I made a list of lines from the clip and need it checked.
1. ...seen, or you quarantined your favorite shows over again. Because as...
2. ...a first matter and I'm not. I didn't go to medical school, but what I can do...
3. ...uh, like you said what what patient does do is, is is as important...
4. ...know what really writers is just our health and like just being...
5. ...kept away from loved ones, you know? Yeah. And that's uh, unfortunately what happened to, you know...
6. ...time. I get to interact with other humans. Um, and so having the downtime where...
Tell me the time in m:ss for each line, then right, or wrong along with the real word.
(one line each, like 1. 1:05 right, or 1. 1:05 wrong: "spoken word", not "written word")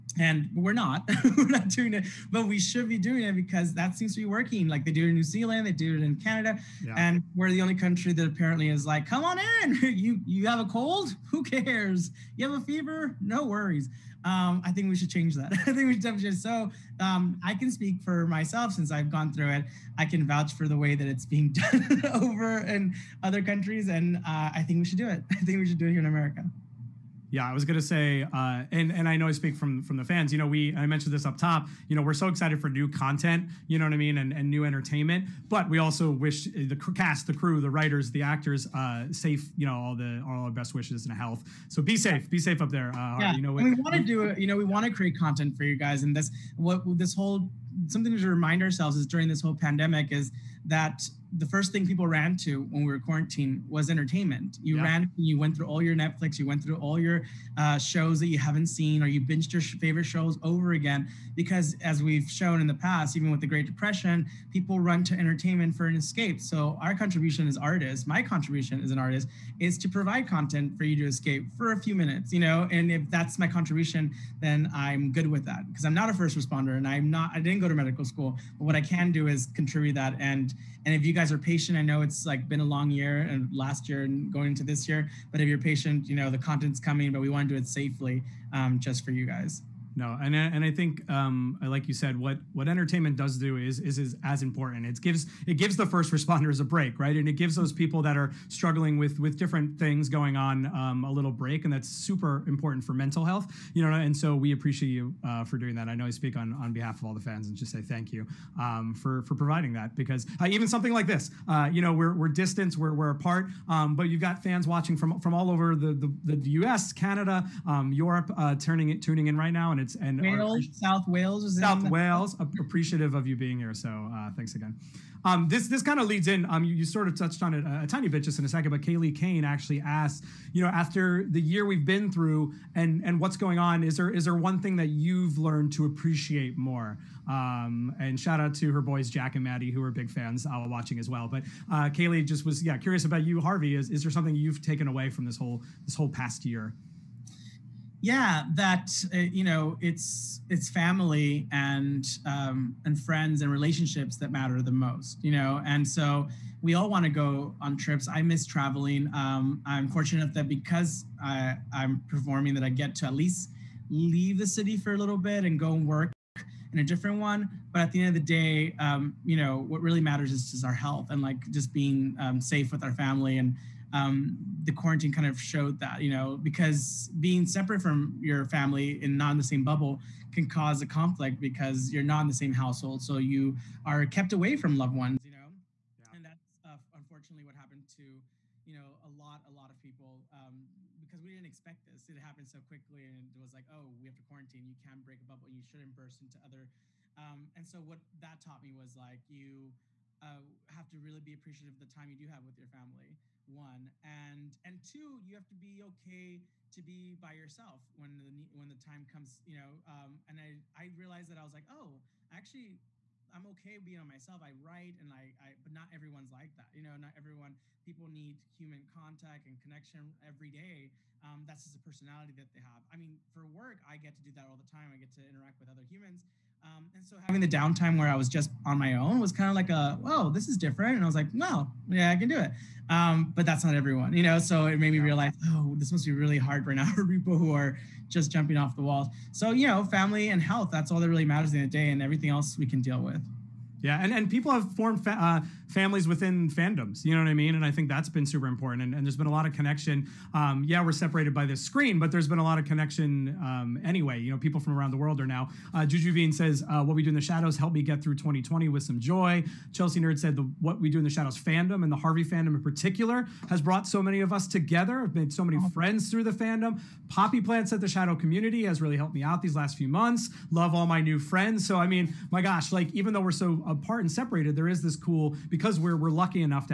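1. 0:58 wrong: "binged", not "quarantined"
2. 1:16 wrong: "responder", not "matter"
3. 1:31 wrong: "entertainment", not "patient"
4. 2:49 wrong: "matters", not "writers"
5. 3:04 right
6. 3:44 right.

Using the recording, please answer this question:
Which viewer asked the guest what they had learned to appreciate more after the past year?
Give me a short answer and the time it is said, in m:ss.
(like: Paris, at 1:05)
Kaylee Kane, at 2:08.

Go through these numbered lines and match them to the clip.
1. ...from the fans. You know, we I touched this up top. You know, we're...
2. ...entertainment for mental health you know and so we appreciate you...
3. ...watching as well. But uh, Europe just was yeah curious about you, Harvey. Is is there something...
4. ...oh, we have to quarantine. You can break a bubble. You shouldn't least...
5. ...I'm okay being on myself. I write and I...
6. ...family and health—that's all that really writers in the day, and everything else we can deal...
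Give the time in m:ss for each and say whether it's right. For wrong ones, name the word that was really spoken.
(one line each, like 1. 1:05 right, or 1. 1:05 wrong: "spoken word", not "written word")
1. 0:29 wrong: "mentioned", not "touched"
2. 1:42 wrong: "important", not "entertainment"
3. 2:20 wrong: "Kaylee", not "Europe"
4. 3:13 wrong: "burst", not "least"
5. 3:33 right
6. 3:59 wrong: "matters", not "writers".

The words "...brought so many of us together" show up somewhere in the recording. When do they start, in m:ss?
4:23.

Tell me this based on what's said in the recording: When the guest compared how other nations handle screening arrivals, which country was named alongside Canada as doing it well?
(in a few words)
New Zealand.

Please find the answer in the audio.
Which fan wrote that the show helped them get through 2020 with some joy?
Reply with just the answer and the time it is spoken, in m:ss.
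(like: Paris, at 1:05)
Juju Bean, at 4:15.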